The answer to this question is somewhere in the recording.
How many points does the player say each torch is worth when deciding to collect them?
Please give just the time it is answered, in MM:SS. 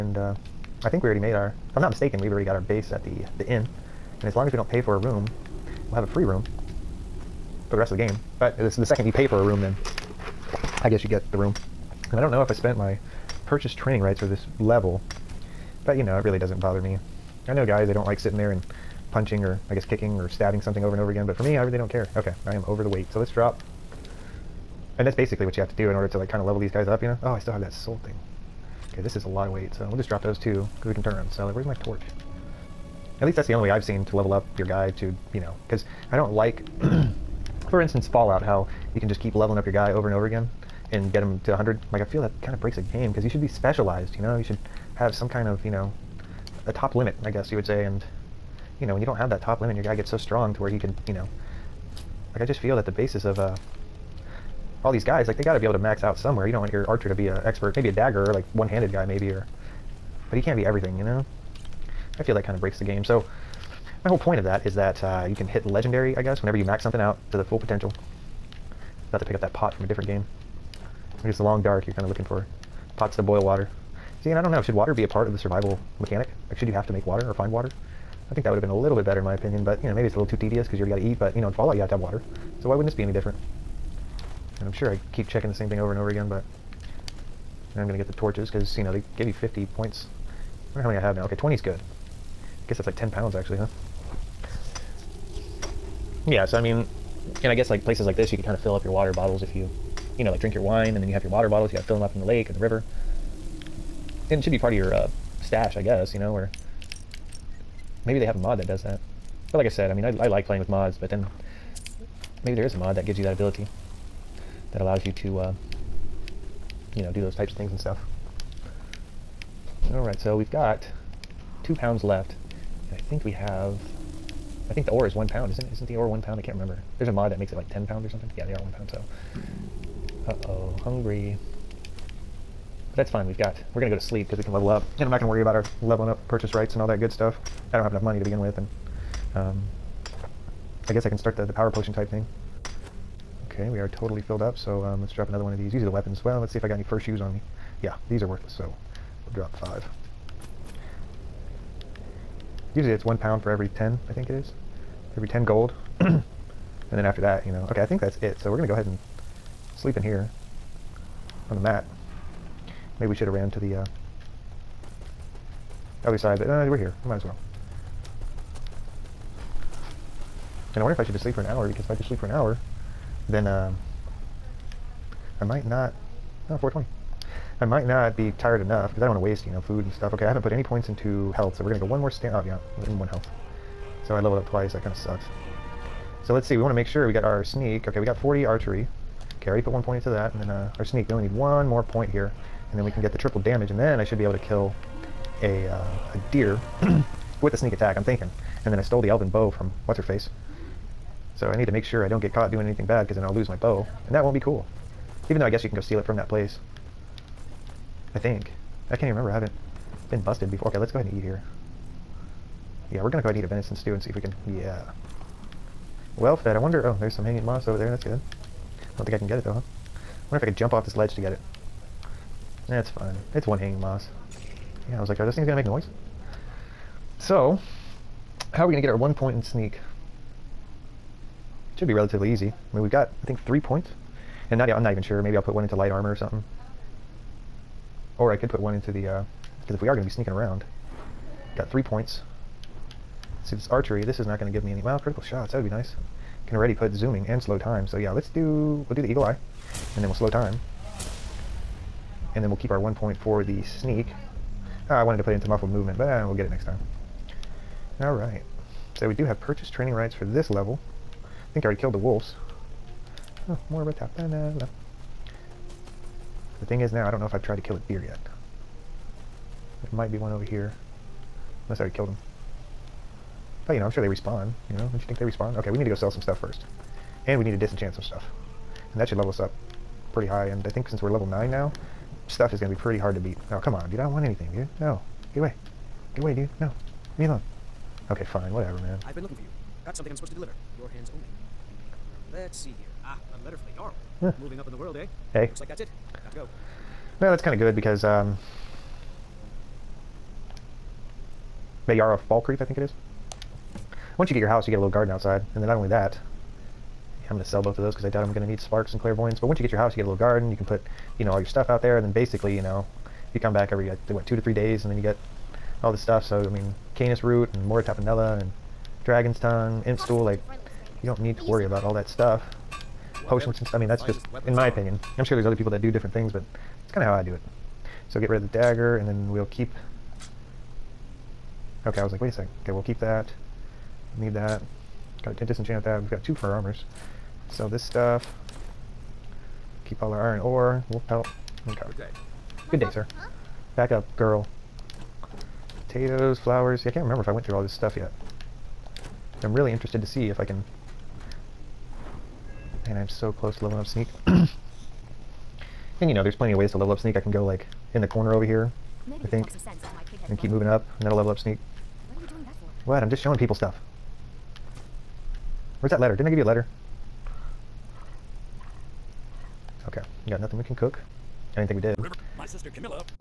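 01:29.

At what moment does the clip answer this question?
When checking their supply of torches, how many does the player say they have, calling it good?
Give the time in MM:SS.
01:31.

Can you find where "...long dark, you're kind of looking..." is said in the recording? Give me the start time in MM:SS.
01:11.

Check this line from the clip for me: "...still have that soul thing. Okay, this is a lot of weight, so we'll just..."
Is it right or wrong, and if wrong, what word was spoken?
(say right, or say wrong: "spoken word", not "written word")
right.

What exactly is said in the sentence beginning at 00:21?
But for me, I really don't care.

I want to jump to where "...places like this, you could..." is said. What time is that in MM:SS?
01:37.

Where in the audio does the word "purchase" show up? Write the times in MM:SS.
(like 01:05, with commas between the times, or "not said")
00:13, 02:16, 04:19.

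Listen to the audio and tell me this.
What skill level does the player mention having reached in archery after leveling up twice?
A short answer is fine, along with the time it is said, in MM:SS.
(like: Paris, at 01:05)
40, at 03:08.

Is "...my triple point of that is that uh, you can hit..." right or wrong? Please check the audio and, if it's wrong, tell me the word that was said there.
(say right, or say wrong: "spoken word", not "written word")
wrong: "whole", not "triple".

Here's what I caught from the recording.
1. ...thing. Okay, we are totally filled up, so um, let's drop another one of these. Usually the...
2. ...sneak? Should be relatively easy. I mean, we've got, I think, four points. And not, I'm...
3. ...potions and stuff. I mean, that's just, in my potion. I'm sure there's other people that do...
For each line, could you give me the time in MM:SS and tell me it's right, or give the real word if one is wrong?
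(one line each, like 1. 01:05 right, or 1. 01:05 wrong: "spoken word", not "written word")
1. 02:22 right
2. 03:49 wrong: "three", not "four"
3. 05:23 wrong: "opinion", not "potion".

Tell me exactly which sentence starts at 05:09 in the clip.
But once you get your house, you get a little garden.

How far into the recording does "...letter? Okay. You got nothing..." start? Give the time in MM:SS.
06:06.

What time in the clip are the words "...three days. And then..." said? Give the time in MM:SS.
05:14.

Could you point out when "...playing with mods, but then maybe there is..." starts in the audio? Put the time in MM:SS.
01:50.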